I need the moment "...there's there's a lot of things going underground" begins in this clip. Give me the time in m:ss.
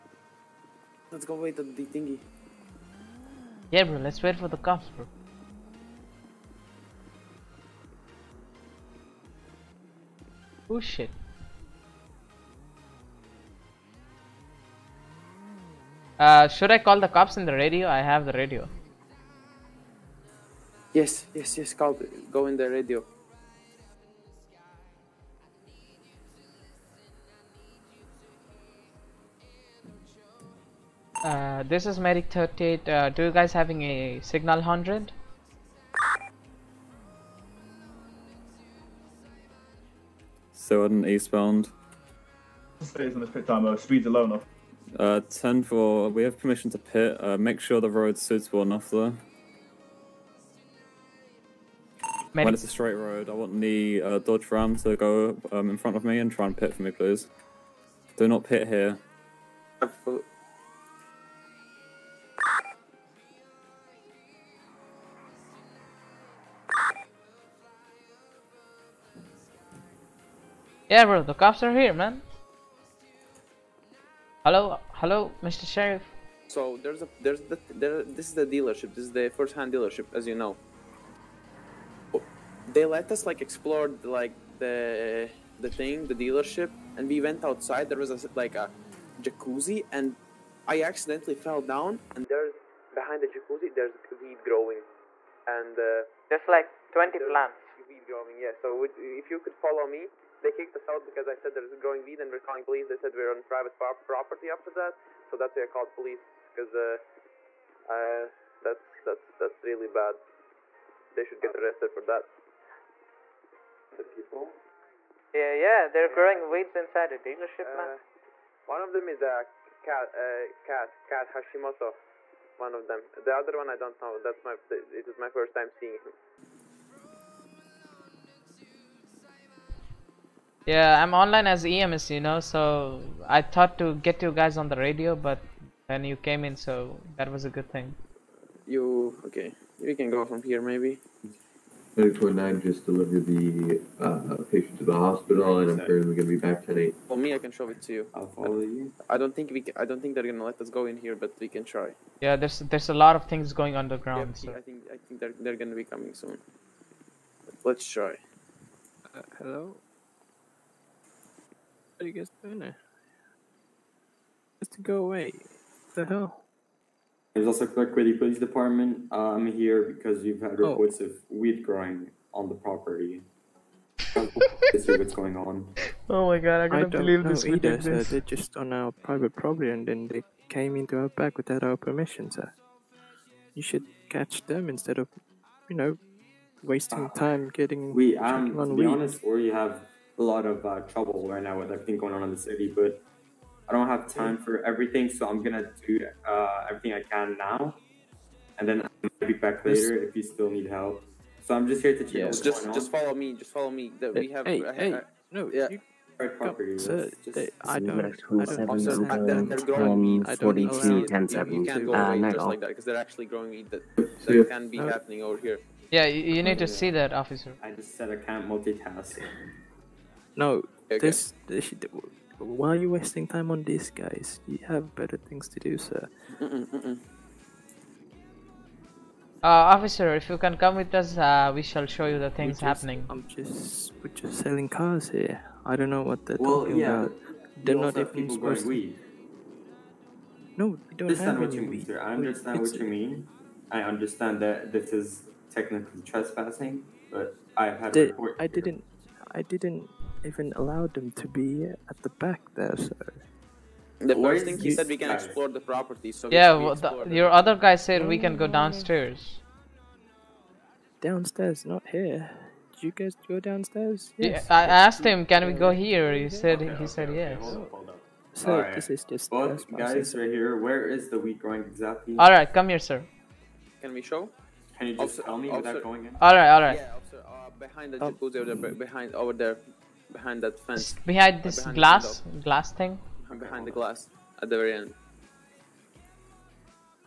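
2:32.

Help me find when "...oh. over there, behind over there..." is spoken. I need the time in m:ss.
4:38.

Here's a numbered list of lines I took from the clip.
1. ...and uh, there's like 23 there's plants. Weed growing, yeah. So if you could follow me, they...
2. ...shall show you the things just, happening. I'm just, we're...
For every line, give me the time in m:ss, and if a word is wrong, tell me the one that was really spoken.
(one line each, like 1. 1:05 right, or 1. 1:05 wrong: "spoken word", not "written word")
1. 1:35 wrong: "20", not "23"
2. 3:51 right.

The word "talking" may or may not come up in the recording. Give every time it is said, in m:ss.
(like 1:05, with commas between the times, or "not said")
3:56.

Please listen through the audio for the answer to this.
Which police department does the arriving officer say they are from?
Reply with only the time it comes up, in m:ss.
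2:47.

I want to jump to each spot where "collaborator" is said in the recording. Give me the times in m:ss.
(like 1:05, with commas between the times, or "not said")
not said.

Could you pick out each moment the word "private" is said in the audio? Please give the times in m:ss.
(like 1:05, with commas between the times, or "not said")
1:43, 2:58.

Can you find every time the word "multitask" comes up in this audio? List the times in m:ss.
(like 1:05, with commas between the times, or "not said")
3:38.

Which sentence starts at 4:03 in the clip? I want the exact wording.
I understand that this is technically trespassing, but I've had.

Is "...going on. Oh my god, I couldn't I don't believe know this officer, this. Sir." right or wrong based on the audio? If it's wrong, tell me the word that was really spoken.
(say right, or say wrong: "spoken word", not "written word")
wrong: "either", not "officer".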